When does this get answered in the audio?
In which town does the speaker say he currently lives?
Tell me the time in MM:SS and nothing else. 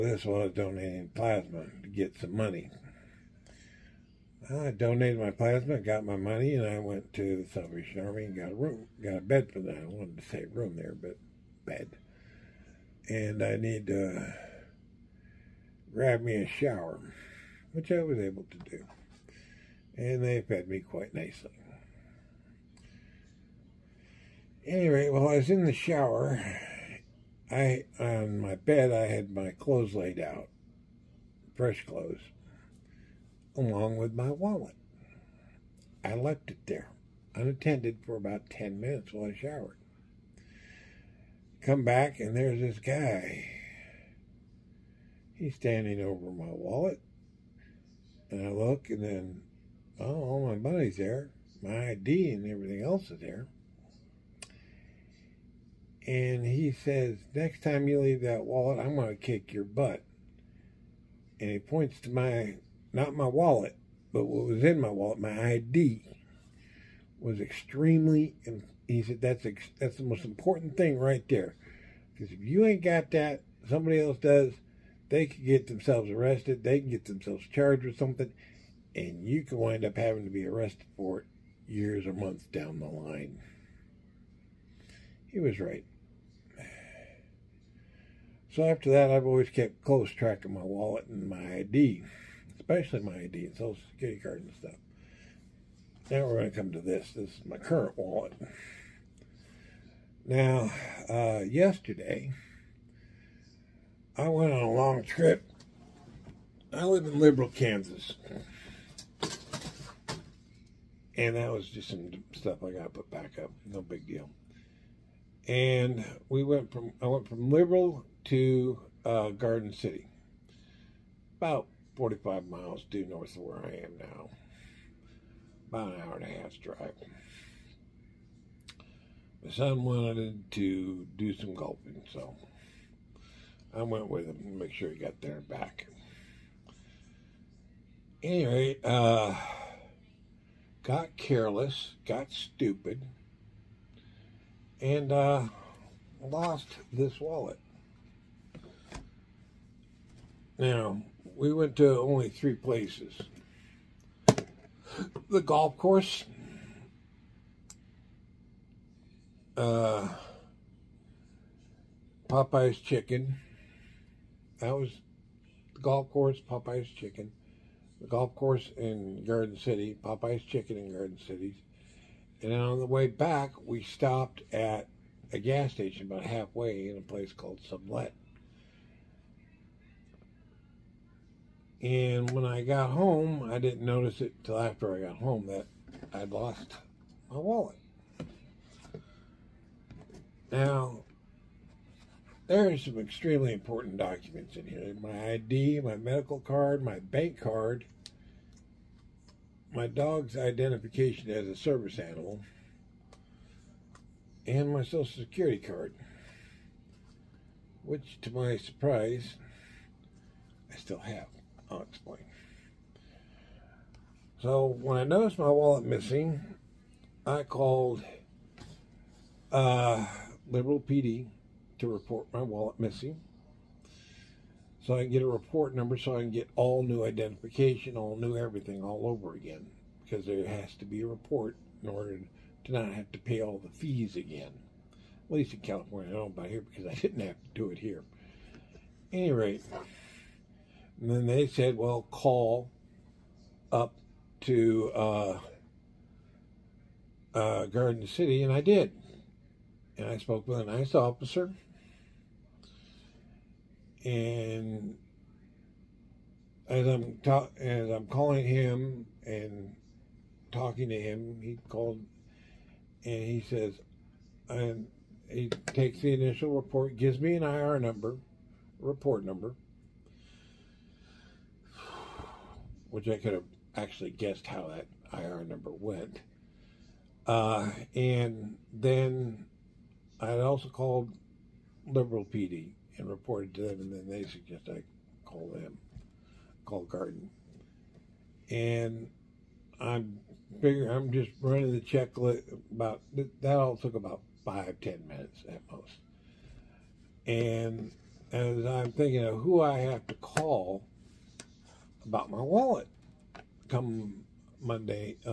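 01:47.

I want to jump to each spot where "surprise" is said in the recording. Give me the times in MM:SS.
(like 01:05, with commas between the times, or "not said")
03:28.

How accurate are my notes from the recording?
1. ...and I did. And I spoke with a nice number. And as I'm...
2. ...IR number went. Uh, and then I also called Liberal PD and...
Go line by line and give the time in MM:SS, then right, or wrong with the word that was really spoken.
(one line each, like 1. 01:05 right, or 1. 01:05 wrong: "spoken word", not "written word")
1. 04:08 wrong: "officer", not "number"
2. 04:35 right.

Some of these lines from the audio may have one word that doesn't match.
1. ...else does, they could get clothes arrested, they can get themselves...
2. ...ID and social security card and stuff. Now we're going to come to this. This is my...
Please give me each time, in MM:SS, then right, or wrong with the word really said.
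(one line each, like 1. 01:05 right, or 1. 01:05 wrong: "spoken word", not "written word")
1. 01:13 wrong: "themselves", not "clothes"
2. 01:33 right.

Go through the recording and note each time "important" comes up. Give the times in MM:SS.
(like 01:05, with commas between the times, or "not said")
01:10, 03:13.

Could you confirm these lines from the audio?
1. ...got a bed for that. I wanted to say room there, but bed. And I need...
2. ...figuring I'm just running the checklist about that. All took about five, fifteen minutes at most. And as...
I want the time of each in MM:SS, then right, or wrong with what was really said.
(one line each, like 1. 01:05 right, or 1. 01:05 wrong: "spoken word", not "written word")
1. 00:09 right
2. 04:50 wrong: "ten", not "fifteen".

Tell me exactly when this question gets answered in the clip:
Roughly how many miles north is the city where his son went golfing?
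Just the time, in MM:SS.
02:01.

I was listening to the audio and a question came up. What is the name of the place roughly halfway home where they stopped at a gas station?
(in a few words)
Sublette.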